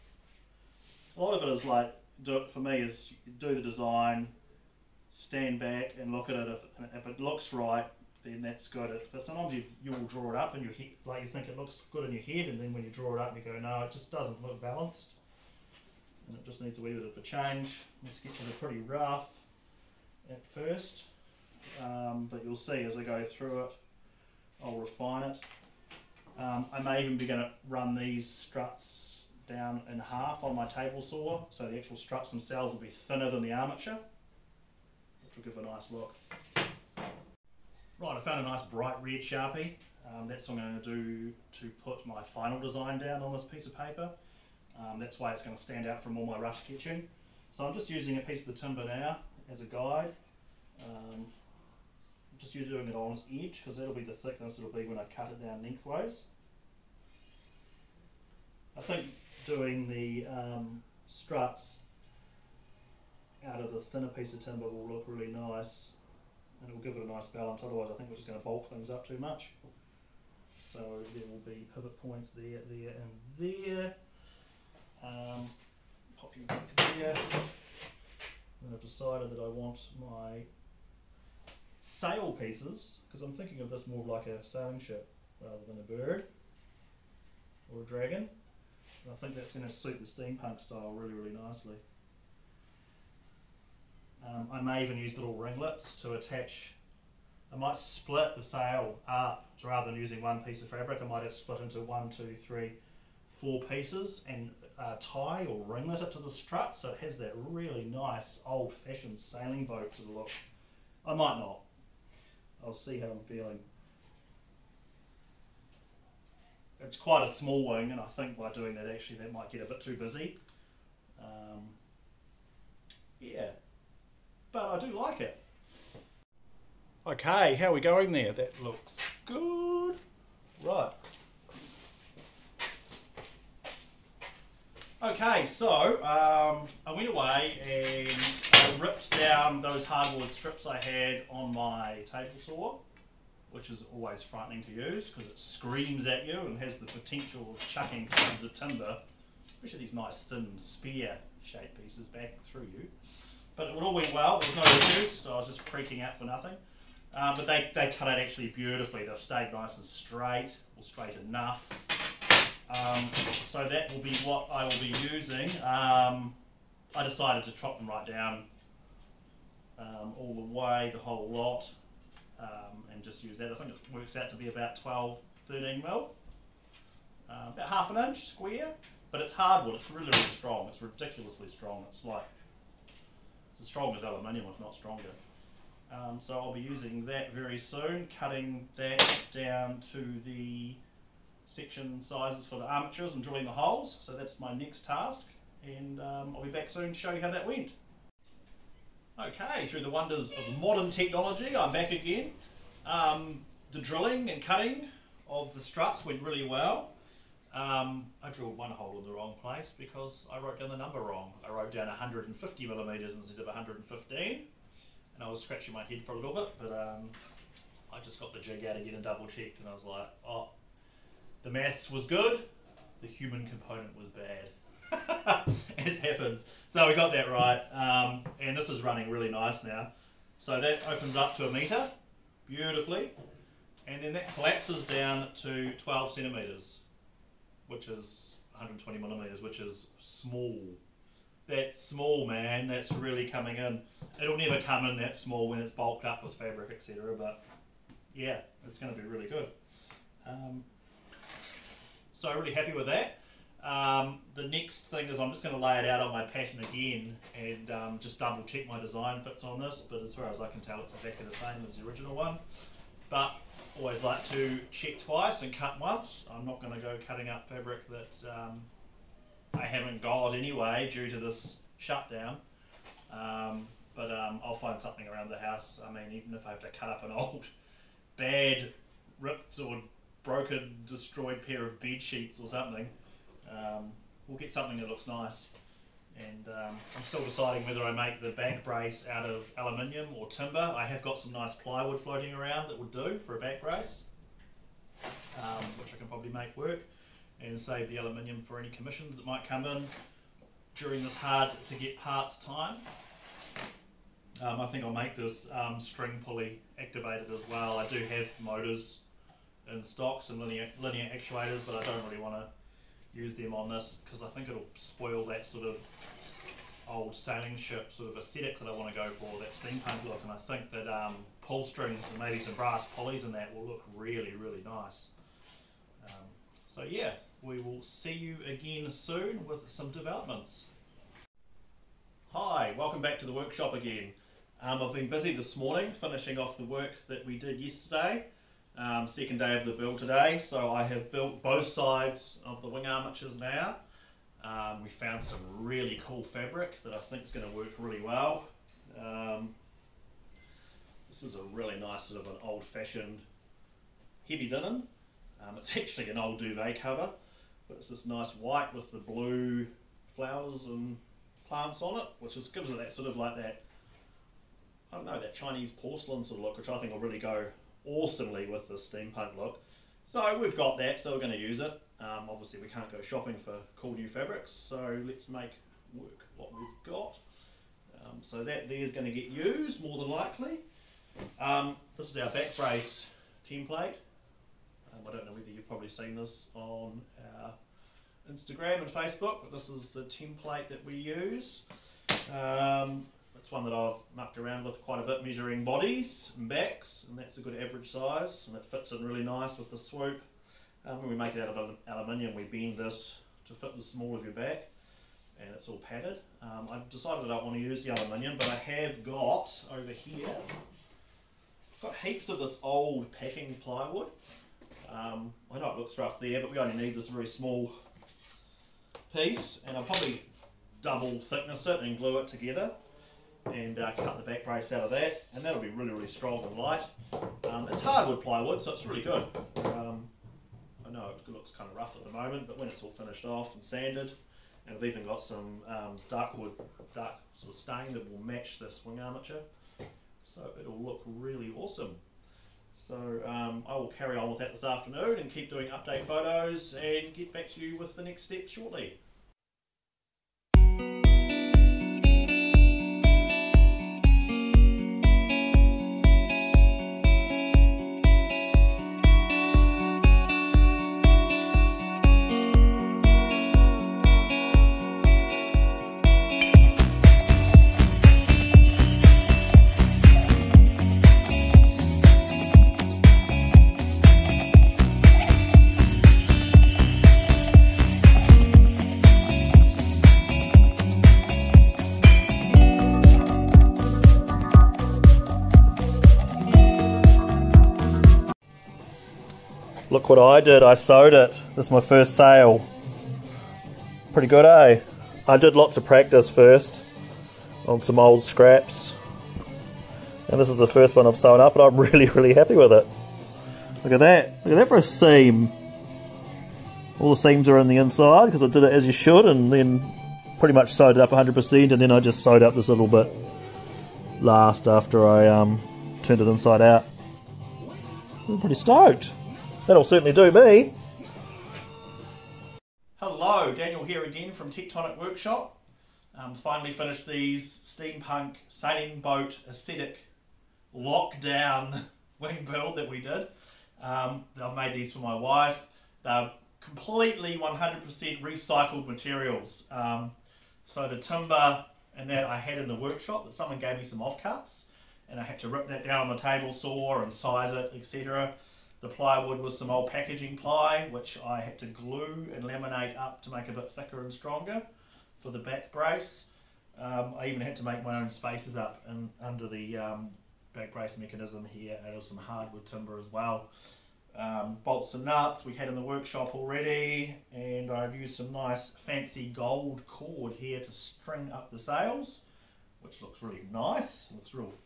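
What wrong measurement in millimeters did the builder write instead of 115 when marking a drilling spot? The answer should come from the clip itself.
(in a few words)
150.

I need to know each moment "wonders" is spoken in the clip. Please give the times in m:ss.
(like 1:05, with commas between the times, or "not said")
3:19.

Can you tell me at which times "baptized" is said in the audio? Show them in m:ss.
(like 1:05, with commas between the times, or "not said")
not said.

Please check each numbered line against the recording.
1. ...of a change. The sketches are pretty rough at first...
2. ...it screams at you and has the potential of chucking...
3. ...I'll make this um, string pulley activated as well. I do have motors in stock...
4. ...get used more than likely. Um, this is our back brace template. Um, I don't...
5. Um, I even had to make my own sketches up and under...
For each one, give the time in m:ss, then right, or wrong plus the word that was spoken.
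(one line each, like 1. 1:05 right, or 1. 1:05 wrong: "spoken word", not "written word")
1. 0:17 right
2. 2:25 right
3. 5:04 right
4. 6:19 right
5. 9:16 wrong: "spaces", not "sketches".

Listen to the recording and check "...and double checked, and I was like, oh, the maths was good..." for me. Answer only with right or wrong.
right.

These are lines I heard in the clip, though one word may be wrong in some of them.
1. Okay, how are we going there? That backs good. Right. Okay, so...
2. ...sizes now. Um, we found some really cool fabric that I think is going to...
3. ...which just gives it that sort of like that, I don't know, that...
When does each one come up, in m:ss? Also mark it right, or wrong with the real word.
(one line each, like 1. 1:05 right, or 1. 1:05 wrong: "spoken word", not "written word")
1. 2:07 wrong: "looks", not "backs"
2. 5:42 wrong: "armatures", not "sizes"
3. 6:02 right.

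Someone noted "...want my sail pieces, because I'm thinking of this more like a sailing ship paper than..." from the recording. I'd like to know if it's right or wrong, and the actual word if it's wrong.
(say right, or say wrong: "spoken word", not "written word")
wrong: "rather", not "paper".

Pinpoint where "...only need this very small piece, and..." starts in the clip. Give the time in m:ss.
6:56.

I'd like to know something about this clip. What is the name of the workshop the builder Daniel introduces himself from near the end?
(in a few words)
Tectonic Workshop.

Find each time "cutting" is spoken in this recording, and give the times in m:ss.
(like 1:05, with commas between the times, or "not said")
3:08, 3:24, 4:27.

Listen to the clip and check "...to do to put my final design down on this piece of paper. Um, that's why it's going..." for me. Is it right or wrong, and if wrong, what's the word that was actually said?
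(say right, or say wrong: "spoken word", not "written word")
right.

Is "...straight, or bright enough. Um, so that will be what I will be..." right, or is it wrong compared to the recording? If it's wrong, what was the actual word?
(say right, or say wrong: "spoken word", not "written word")
wrong: "straight", not "bright".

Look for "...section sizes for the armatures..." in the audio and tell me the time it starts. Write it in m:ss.
3:11.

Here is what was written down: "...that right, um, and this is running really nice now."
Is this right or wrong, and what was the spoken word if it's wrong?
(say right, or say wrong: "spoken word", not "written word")
right.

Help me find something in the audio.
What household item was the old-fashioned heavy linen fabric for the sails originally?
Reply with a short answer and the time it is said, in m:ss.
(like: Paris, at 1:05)
duvet cover, at 5:56.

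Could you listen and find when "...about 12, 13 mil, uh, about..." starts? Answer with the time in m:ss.
2:54.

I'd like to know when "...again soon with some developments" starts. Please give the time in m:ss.
5:28.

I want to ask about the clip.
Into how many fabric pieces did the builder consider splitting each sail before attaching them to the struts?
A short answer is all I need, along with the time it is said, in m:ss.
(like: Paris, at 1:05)
4, at 1:43.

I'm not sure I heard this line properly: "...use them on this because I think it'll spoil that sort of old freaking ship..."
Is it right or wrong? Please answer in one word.
wrong.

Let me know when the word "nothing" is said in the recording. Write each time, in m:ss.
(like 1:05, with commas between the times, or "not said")
2:36.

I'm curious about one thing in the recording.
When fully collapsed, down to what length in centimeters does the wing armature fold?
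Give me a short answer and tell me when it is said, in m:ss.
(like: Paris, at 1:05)
12, at 3:55.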